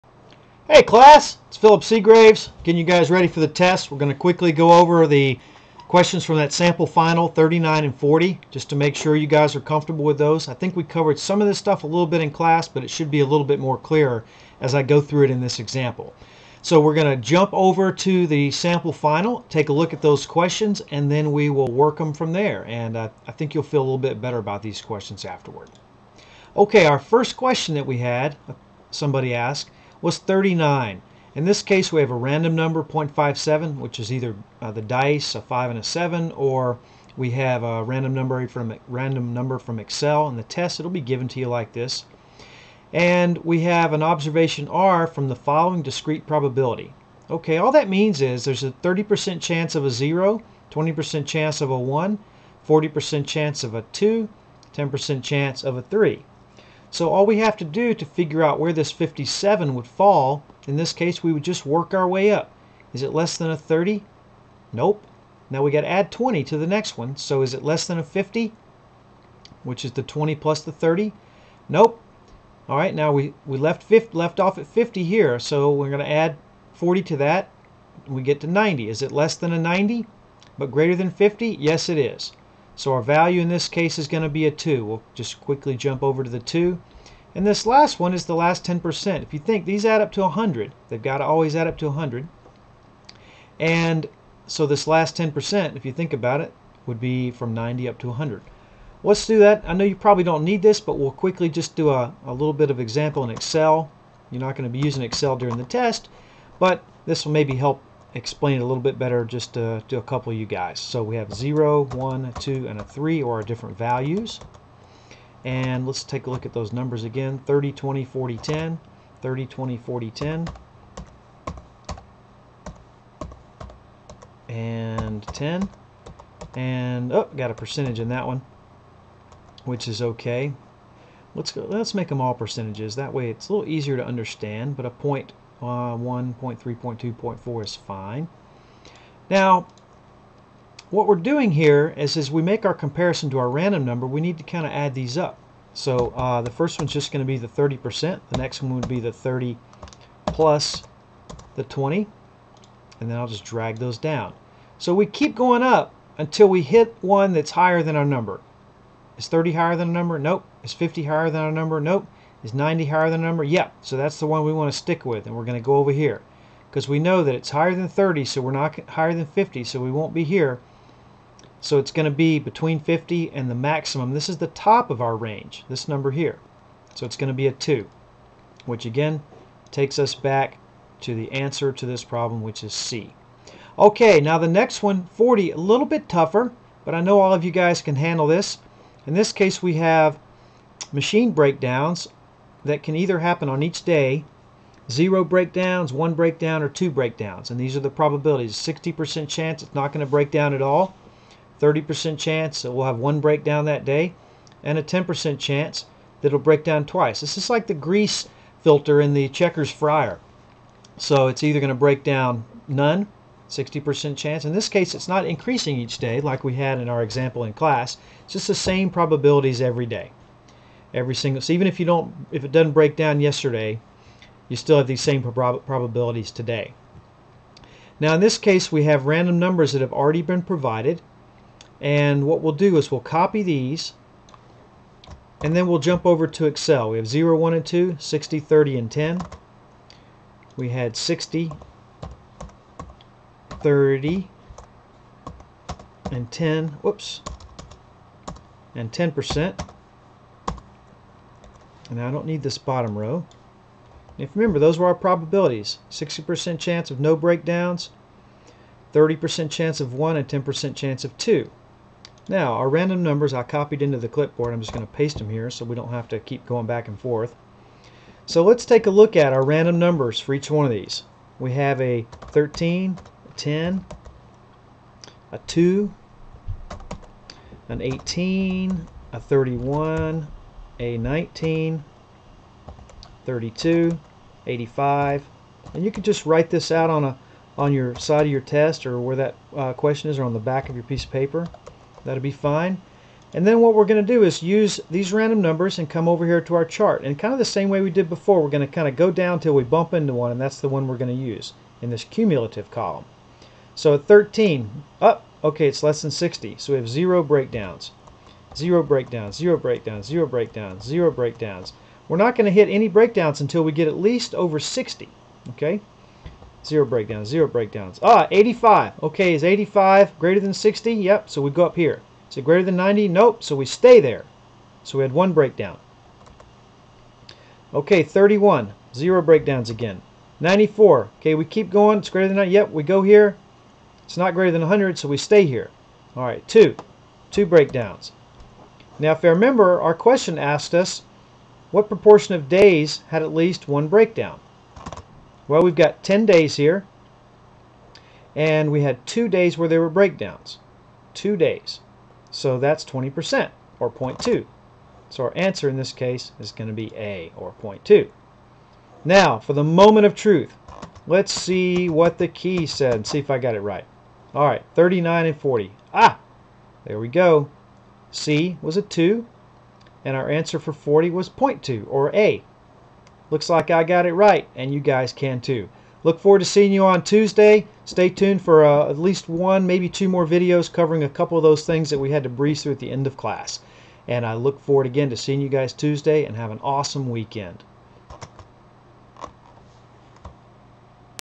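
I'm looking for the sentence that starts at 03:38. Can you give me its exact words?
It's just the same probabilities every day every single.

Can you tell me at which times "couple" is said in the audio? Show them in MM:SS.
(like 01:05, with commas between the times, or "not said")
01:50, 06:21.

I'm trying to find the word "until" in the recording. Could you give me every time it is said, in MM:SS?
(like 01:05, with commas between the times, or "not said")
02:36, 05:13.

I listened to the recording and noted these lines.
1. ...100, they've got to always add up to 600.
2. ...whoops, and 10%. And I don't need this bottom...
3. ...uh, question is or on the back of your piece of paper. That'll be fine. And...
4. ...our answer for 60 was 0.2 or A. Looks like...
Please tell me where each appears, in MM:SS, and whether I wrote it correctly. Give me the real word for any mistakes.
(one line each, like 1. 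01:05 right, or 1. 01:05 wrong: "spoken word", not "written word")
1. 01:30 wrong: "100", not "600"
2. 04:06 right
3. 04:49 right
4. 06:10 wrong: "40", not "60".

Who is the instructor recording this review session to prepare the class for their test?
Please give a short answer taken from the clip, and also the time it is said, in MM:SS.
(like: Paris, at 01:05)
Philip Seagraves, at 00:01.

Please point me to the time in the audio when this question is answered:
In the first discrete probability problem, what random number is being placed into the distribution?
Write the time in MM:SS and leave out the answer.
00:32.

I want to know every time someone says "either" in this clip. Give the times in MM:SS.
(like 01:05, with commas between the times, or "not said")
00:34, 03:12, 03:31.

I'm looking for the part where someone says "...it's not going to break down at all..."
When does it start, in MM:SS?
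03:19.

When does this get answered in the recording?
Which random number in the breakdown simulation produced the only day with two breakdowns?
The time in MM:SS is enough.
05:30.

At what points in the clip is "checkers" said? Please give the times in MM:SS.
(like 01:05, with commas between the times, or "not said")
03:29.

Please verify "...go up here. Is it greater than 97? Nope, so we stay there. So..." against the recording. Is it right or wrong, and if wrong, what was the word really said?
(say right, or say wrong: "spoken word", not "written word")
wrong: "90", not "97".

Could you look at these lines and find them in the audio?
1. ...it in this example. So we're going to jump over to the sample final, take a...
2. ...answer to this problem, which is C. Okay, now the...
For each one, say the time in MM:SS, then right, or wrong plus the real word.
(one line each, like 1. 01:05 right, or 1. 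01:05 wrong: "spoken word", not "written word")
1. 00:15 right
2. 03:01 right.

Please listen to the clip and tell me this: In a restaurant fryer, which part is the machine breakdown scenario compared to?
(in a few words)
grease filter.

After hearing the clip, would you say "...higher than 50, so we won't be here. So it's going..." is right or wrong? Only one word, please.
right.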